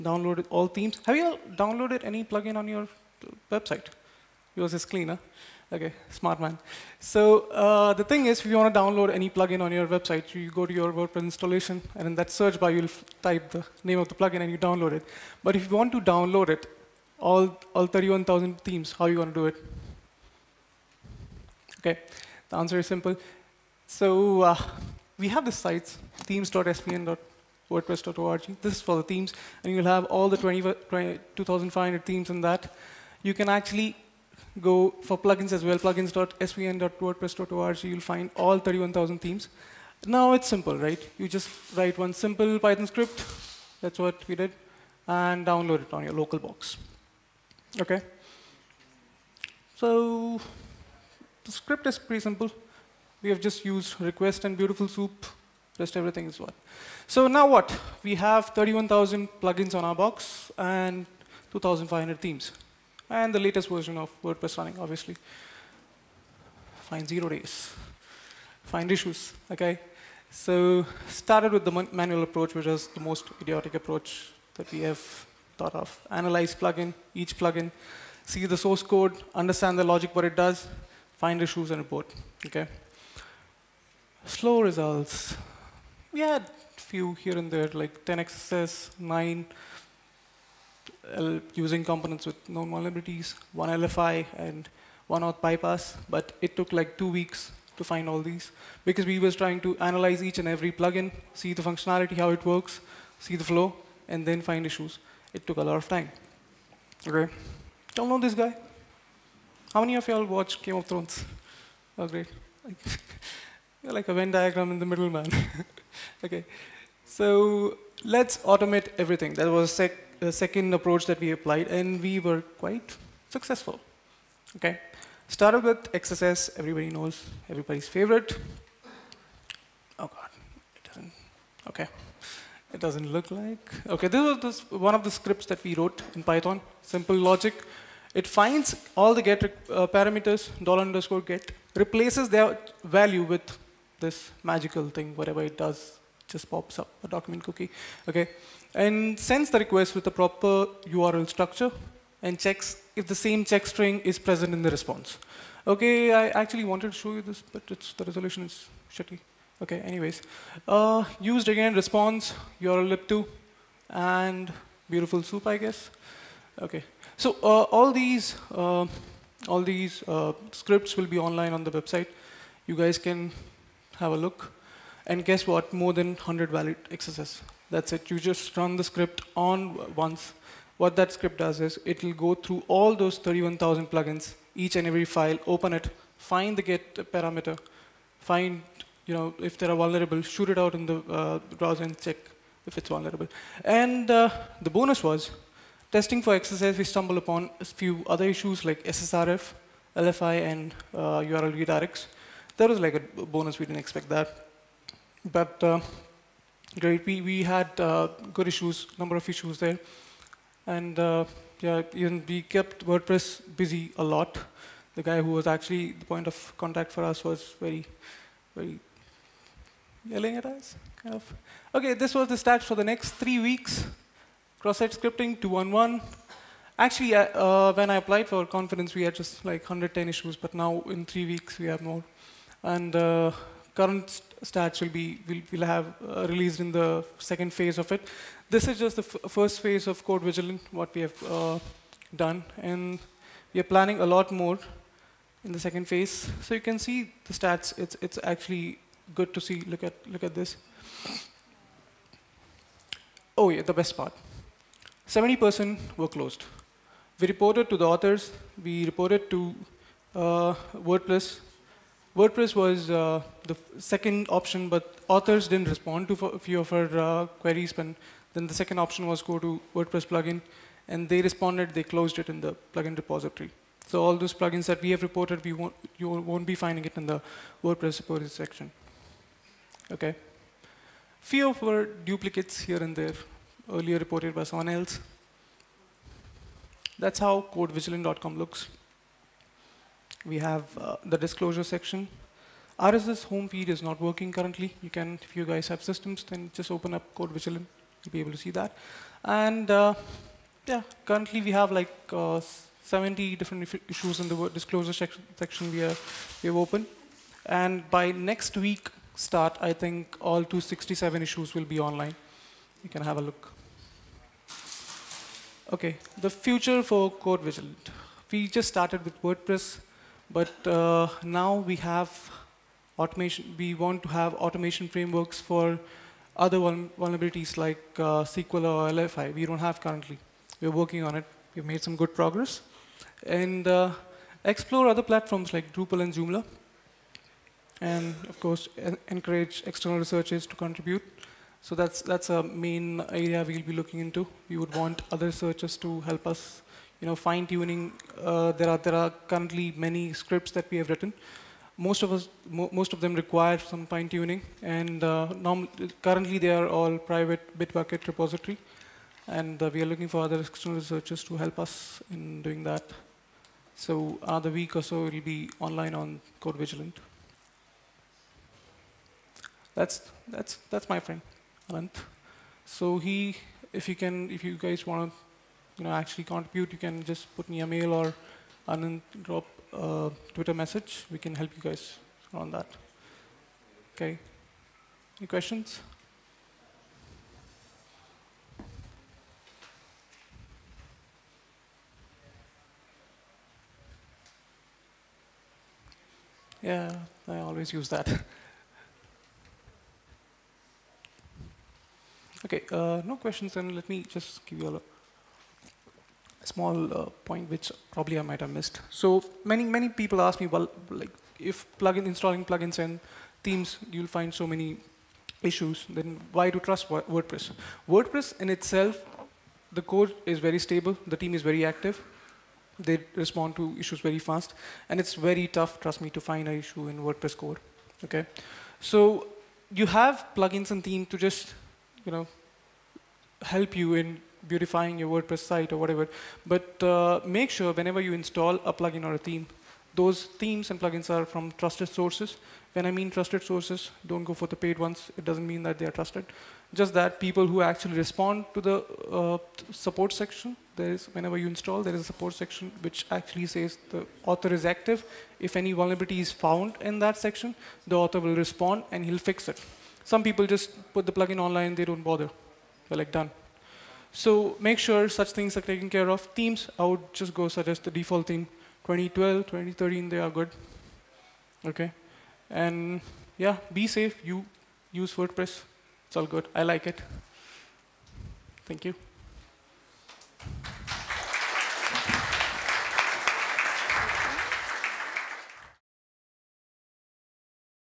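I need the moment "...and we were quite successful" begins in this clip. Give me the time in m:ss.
2:01.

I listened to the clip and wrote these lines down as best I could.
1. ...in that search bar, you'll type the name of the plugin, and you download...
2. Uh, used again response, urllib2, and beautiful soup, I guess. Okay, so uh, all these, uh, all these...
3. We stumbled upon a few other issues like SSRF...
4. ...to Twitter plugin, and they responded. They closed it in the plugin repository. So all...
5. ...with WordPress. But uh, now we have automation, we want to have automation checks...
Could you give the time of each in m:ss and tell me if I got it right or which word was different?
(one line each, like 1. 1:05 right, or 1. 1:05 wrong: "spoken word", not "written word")
1. 0:12 right
2. 2:40 right
3. 3:16 right
4. 4:29 wrong: "WordPress", not "Twitter"
5. 5:19 wrong: "frameworks", not "checks".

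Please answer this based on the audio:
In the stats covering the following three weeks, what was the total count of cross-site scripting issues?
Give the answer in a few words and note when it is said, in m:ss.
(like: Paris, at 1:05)
211, at 3:45.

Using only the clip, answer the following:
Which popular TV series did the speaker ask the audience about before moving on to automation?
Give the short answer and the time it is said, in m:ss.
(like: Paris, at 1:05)
Game of Thrones, at 1:50.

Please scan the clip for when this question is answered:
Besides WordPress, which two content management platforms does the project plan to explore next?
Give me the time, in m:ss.
5:35.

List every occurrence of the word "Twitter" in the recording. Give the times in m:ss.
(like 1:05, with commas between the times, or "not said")
6:20.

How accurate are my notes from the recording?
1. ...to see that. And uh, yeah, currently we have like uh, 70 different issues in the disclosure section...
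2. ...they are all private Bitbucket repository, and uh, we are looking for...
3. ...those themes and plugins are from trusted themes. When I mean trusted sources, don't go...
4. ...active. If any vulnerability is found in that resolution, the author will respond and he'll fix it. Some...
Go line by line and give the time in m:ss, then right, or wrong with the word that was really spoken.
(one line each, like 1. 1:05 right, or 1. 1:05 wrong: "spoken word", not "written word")
1. 4:58 right
2. 5:56 right
3. 7:19 wrong: "sources", not "themes"
4. 7:34 wrong: "section", not "resolution".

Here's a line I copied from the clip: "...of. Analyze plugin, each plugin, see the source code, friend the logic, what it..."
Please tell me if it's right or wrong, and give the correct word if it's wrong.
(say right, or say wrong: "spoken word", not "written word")
wrong: "understand", not "friend".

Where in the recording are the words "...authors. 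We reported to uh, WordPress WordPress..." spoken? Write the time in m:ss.
4:17.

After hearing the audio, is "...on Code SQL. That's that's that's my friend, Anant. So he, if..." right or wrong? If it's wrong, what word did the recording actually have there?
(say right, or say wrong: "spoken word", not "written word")
wrong: "Vigilant", not "SQL".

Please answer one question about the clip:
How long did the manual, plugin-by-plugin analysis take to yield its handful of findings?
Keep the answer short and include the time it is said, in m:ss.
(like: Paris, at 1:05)
two weeks, at 1:36.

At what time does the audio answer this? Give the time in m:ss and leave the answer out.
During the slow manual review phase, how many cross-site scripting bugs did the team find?
1:28.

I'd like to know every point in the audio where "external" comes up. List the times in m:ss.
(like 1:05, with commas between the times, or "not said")
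5:39, 6:00.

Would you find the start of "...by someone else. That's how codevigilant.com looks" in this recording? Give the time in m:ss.
4:44.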